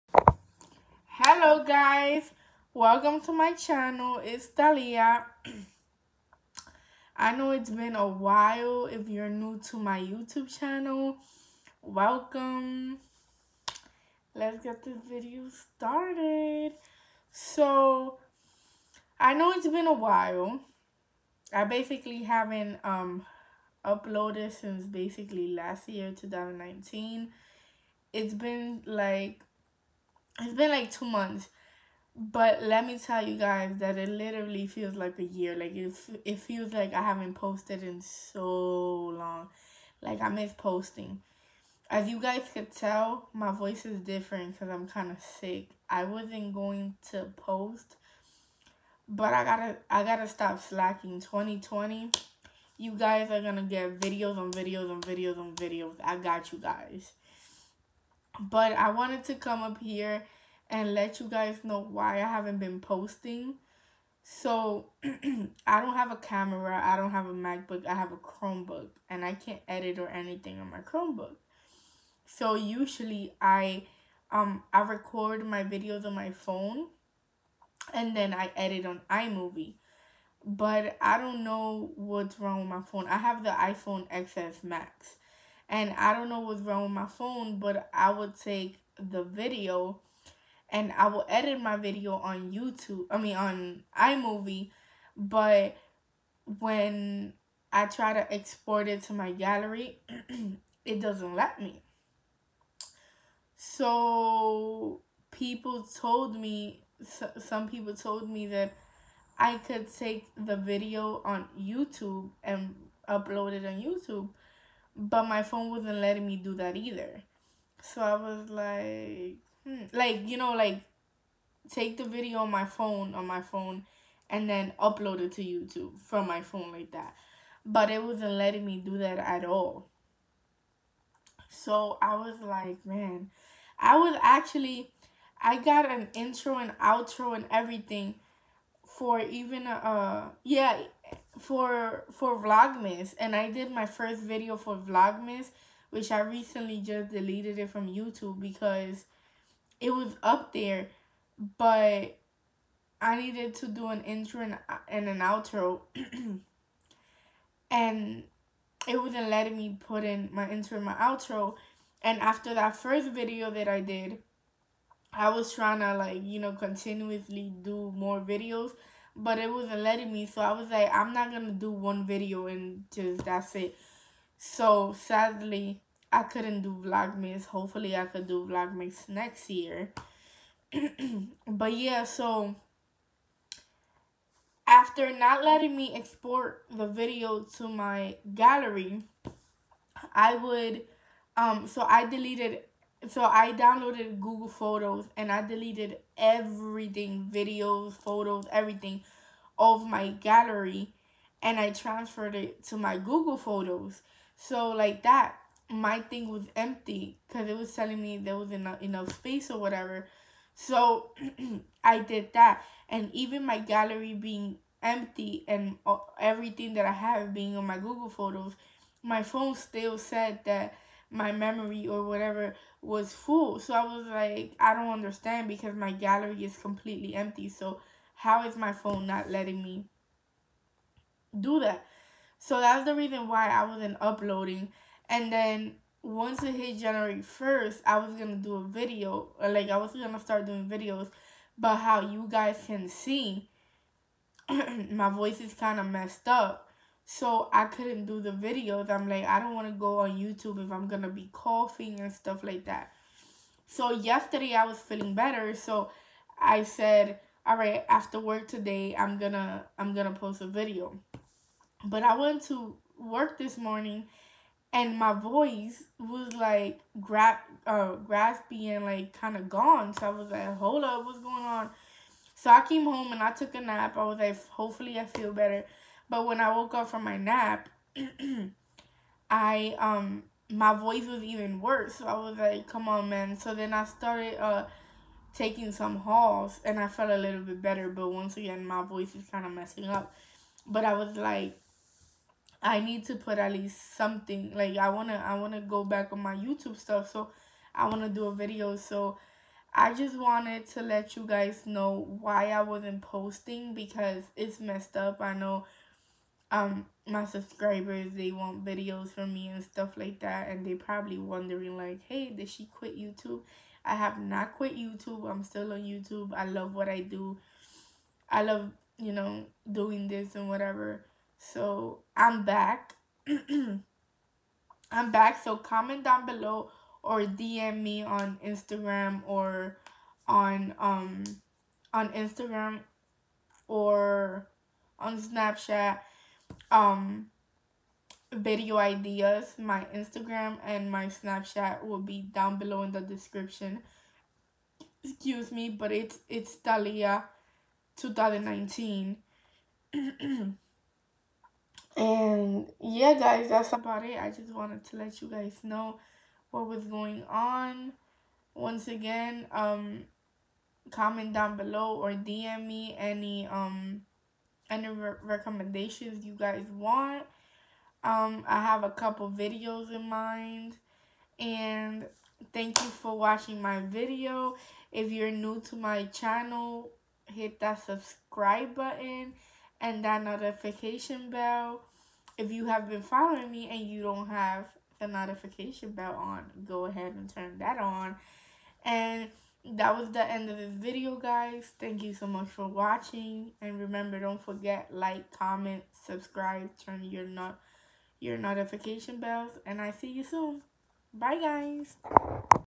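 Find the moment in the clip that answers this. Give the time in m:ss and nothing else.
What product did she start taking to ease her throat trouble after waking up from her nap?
4:45.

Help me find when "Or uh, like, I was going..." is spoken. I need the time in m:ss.
3:59.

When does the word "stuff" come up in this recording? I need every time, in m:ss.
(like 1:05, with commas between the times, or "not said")
4:12, 4:56, 5:09.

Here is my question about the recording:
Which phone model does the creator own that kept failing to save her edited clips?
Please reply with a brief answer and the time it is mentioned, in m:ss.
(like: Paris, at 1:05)
iPhone XS Max, at 1:23.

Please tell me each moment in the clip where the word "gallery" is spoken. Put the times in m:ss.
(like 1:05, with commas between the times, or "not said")
1:39, 3:08, 3:20, 3:33, 3:45.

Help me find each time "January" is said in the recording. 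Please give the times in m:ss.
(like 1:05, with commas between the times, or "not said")
3:56.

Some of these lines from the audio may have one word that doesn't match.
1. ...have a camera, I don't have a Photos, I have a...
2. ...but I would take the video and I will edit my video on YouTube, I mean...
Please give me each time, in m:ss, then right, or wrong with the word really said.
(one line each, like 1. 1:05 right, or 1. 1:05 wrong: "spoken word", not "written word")
1. 1:05 wrong: "MacBook", not "Photos"
2. 1:27 right.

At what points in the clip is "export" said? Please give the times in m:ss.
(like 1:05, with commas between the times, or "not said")
1:38, 3:05.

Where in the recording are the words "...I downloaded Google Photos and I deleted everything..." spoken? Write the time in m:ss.
3:13.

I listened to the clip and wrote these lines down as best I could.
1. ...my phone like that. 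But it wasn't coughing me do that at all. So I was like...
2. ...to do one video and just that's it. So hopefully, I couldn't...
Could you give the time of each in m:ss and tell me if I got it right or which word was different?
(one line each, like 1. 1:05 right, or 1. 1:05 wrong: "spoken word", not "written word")
1. 2:06 wrong: "letting", not "coughing"
2. 2:51 wrong: "sadly", not "hopefully".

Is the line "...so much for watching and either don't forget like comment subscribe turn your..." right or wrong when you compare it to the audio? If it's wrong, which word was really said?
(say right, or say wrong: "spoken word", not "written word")
wrong: "remember", not "either".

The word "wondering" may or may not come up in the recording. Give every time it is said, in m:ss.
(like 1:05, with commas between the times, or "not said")
5:11.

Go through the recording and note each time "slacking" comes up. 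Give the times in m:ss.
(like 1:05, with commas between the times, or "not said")
0:50.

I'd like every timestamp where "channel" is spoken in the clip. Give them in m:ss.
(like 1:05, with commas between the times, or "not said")
0:03, 0:10, 6:16.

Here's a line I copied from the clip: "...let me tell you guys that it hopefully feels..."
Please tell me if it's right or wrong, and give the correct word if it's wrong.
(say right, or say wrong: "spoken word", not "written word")
wrong: "literally", not "hopefully".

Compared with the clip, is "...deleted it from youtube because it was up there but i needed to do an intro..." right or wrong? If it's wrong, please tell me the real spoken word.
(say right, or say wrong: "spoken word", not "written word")
right.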